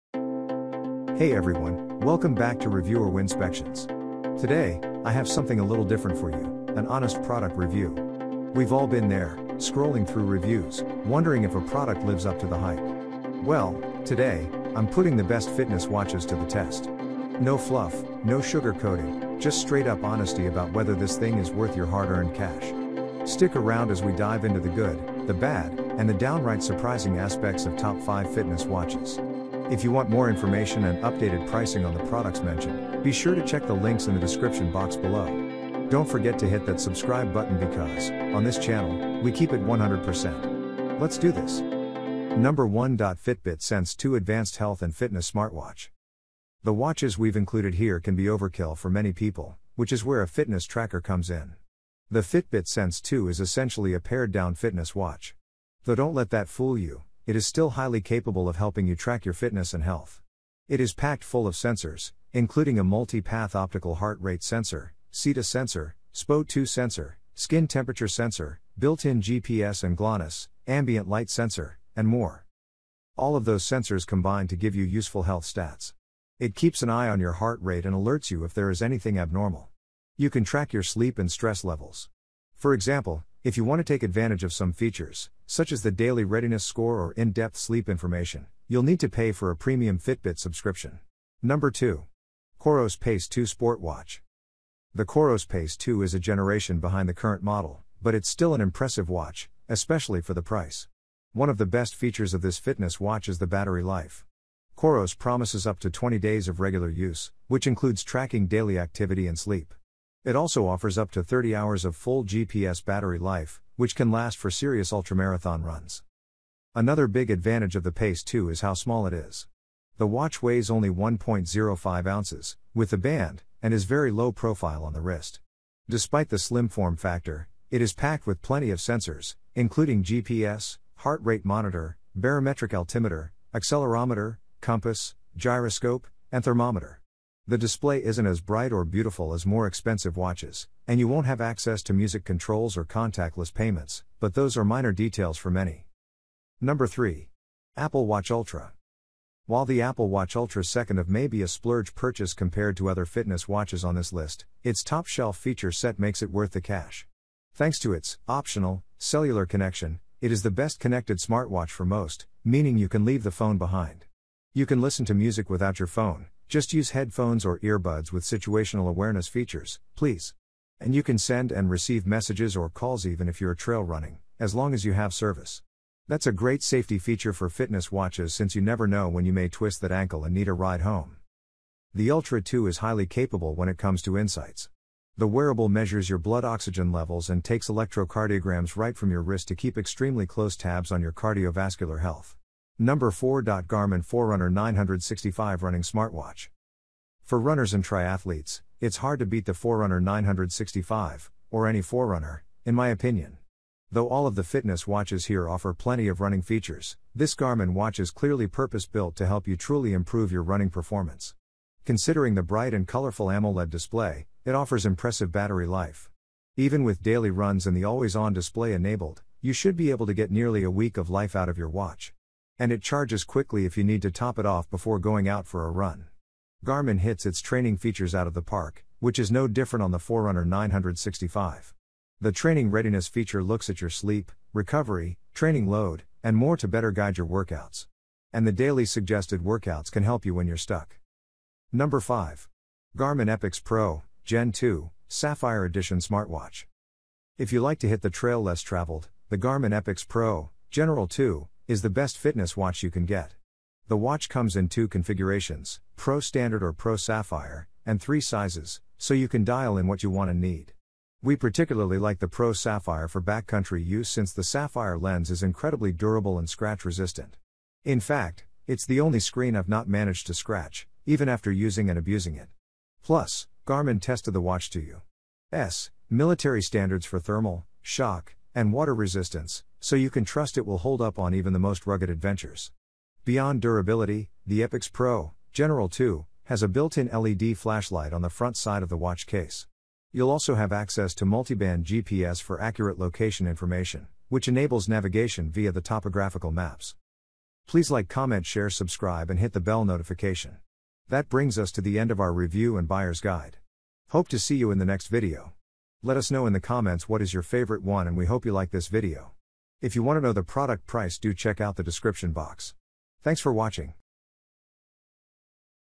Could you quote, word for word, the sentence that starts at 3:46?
Garmin hits its training features out of the park, which is no different on the Forerunner 965.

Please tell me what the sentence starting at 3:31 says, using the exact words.
Considering the bright and colorful AMOLED display, it offers impressive battery life.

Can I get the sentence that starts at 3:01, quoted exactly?
The Ultra 2 is highly capable when it comes to insights.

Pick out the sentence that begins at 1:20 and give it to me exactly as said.
You can track your sleep and stress levels.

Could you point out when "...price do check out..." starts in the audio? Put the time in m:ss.
5:10.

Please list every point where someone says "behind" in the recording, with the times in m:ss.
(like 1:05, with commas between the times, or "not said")
1:36, 2:43.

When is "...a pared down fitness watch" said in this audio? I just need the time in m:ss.
0:53.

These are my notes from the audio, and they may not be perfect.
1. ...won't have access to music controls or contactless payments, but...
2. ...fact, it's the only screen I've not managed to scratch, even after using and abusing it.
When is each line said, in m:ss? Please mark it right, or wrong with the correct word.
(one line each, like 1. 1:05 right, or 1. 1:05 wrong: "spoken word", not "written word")
1. 2:21 right
2. 4:28 right.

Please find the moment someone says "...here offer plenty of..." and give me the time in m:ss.
3:25.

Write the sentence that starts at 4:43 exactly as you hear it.
Beyond durability, the Epix Pro General 2 has a built in LED flashlight on the front side of the watch case.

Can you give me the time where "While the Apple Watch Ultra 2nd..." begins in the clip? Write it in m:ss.
2:29.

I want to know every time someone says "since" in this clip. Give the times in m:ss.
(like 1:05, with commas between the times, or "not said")
2:58, 4:24.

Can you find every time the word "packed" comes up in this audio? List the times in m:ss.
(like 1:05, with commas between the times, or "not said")
1:00, 2:07.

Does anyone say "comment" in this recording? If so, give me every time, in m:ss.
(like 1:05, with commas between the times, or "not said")
4:58, 5:06.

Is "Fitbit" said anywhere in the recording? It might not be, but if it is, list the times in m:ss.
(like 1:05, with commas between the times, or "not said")
0:42, 0:52, 1:29.